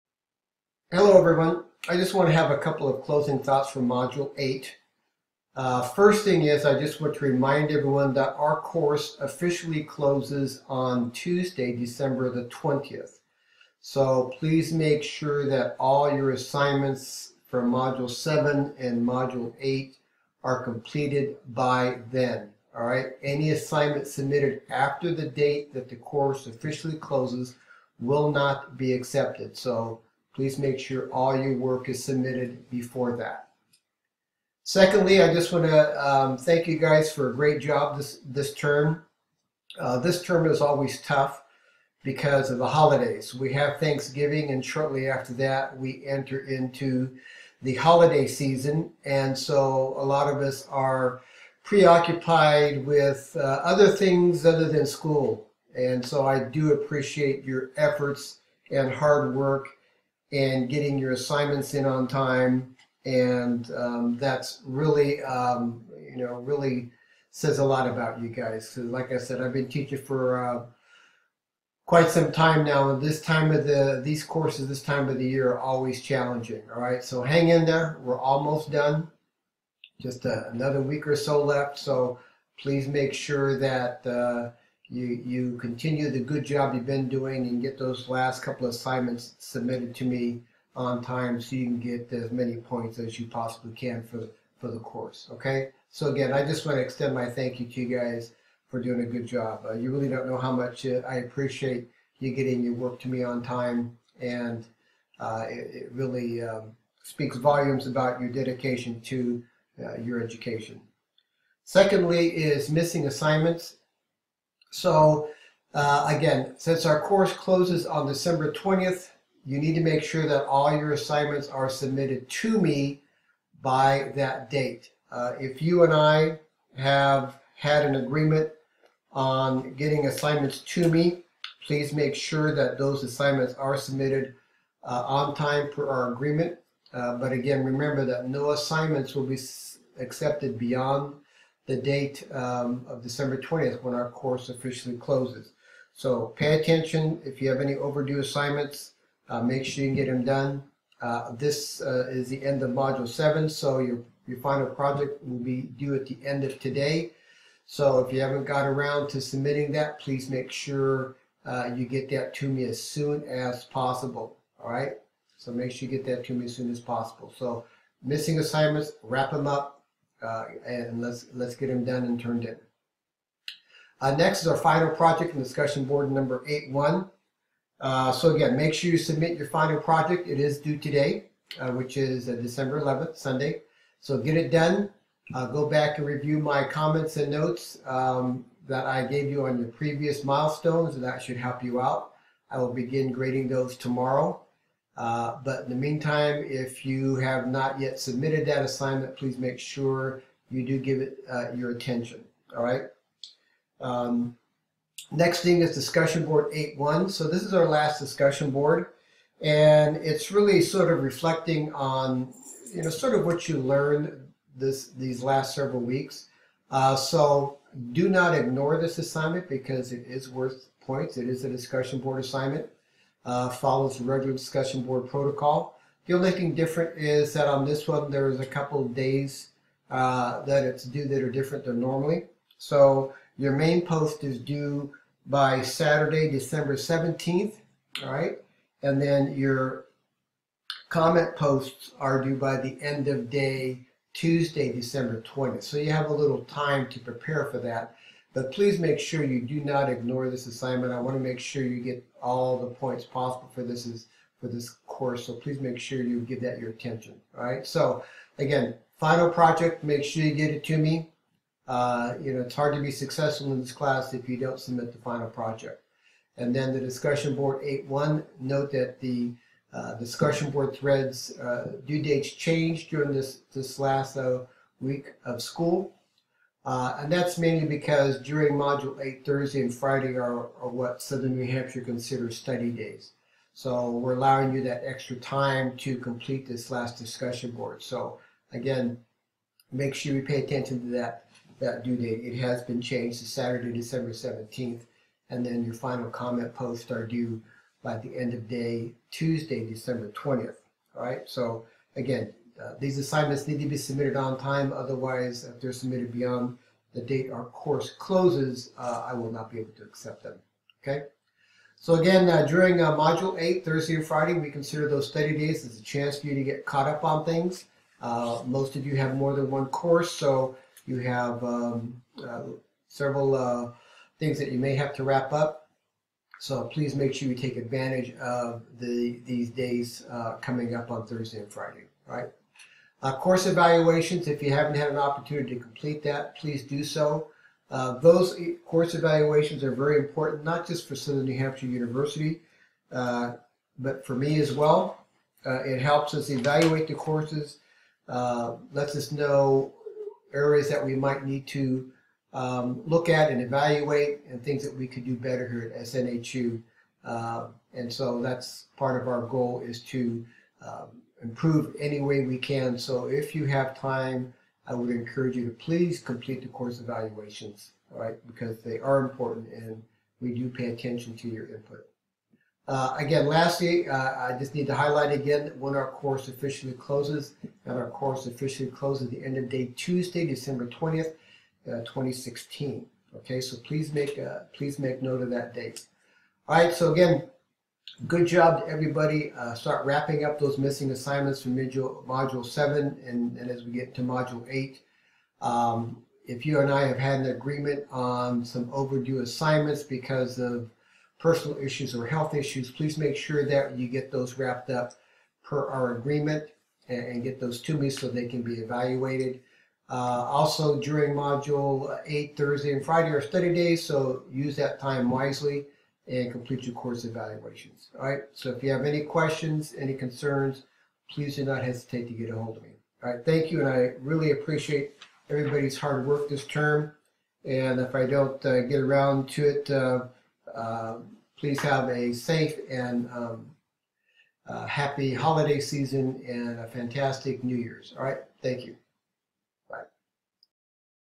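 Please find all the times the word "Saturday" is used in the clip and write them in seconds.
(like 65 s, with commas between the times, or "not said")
235 s, 293 s.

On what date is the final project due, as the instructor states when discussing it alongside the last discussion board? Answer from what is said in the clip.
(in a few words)
December 11th.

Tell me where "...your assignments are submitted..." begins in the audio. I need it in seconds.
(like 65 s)
120 s.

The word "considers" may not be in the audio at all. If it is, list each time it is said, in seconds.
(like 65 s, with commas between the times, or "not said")
281 s, 314 s.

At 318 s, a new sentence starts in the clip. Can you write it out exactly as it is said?
Uh, most of you have more than one course, so you have um, several things that you may have to wrap up.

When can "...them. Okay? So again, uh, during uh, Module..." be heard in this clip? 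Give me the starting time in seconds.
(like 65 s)
310 s.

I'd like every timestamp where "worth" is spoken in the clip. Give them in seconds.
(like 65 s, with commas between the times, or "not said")
220 s.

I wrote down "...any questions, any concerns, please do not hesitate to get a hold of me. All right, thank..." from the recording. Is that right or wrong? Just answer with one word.
right.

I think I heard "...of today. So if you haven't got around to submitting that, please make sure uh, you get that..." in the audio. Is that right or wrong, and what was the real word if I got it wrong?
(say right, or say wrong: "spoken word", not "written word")
right.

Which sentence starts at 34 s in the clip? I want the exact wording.
Secondly, I just want to um, thank you guys for a great job this, this term.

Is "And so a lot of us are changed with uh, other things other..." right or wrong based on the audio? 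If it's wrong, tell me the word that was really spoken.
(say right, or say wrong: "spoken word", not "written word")
wrong: "preoccupied", not "changed".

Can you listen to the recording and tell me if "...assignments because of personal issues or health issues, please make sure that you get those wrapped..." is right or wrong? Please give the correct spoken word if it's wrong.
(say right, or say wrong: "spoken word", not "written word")
right.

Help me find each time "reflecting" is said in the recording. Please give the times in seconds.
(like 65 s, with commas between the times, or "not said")
211 s.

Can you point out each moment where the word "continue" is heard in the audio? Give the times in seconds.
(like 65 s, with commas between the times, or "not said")
85 s.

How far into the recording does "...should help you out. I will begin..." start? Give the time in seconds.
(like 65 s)
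191 s.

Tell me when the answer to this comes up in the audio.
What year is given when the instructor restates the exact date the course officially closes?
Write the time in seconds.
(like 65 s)
381 s.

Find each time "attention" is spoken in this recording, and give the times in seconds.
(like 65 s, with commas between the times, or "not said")
146 s, 201 s, 256 s, 290 s, 370 s.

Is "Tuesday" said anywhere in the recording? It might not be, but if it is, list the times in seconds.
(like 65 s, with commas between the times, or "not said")
11 s, 244 s, 299 s, 379 s.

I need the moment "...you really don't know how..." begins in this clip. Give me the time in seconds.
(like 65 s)
99 s.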